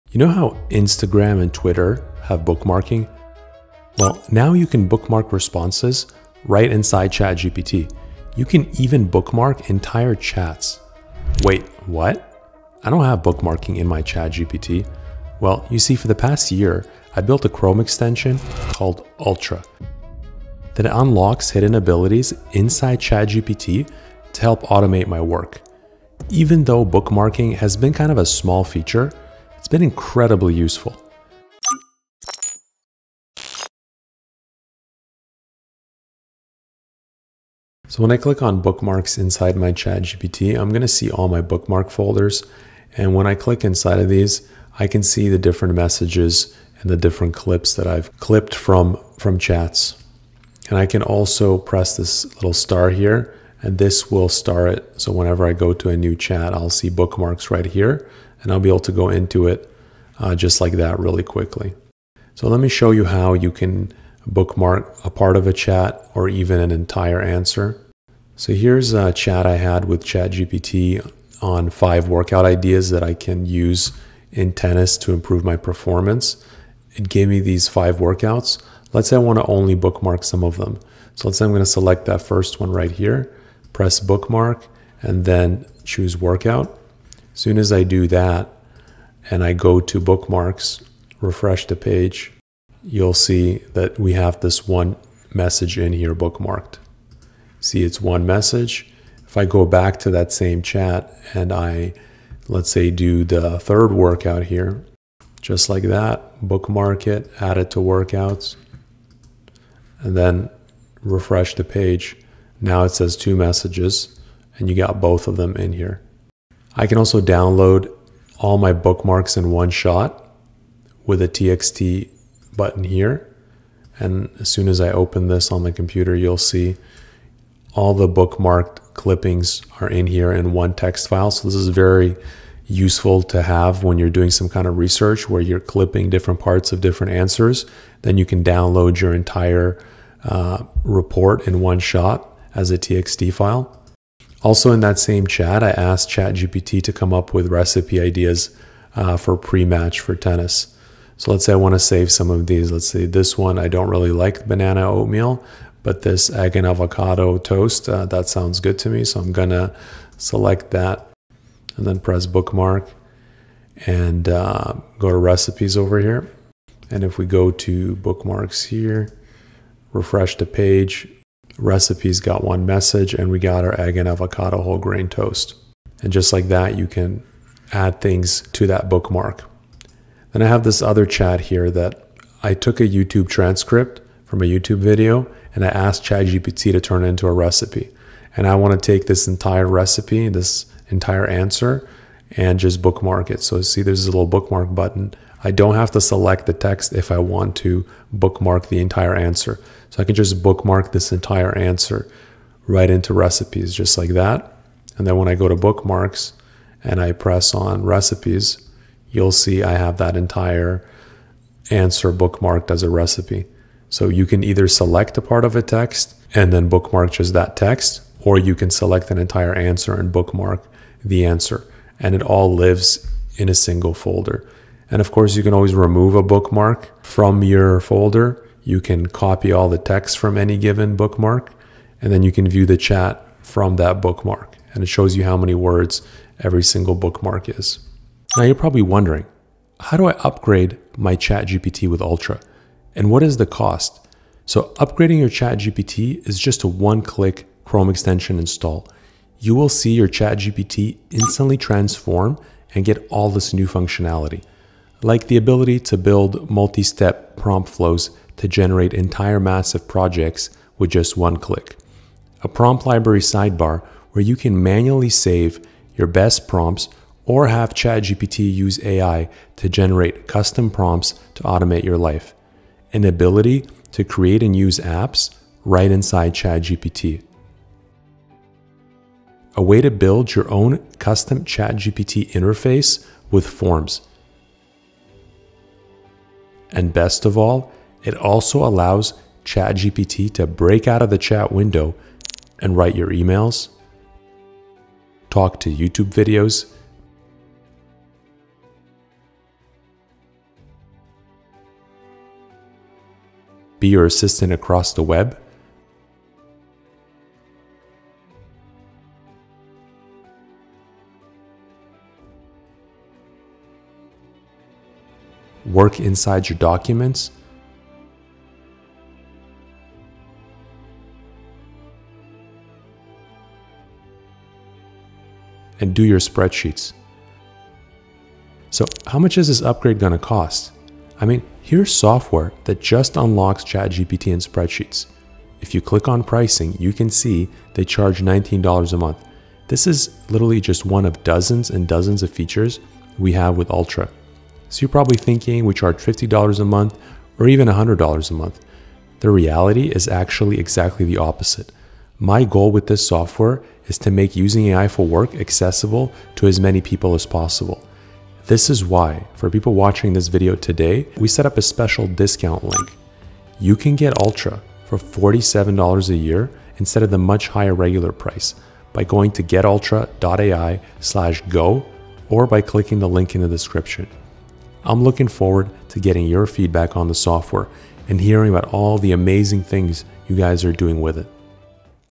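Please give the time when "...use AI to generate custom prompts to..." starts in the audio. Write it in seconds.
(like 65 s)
268 s.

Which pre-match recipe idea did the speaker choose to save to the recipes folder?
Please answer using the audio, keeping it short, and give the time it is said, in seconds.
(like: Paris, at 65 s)
Egg and avocado toast, at 156 s.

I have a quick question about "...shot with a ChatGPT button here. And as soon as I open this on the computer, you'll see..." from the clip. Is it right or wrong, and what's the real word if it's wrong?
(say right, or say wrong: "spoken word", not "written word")
wrong: "TXT", not "ChatGPT".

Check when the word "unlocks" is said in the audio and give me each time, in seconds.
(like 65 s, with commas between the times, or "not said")
20 s, 333 s.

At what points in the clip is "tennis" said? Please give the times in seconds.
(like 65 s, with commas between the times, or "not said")
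74 s, 150 s.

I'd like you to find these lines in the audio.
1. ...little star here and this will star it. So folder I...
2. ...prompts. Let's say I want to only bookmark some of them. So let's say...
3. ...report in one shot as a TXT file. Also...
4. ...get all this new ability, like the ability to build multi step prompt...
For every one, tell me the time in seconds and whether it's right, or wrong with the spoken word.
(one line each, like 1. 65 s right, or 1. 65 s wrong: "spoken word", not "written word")
1. 52 s wrong: "whenever", not "folder"
2. 77 s wrong: "workouts", not "prompts"
3. 140 s right
4. 252 s wrong: "functionality", not "ability".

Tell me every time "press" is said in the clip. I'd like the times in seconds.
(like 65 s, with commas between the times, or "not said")
51 s, 83 s, 161 s, 207 s.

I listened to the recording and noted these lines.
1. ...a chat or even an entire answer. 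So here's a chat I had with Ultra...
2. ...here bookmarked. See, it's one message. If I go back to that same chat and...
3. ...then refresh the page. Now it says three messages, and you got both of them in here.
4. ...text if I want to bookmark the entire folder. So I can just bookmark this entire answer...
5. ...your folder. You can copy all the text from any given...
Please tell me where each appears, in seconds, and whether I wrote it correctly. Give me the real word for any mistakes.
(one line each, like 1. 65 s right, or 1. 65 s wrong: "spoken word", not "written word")
1. 65 s wrong: "ChatGPT", not "Ultra"
2. 95 s right
3. 110 s wrong: "two", not "three"
4. 196 s wrong: "answer", not "folder"
5. 227 s right.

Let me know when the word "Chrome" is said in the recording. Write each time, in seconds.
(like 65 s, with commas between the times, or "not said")
17 s, 247 s.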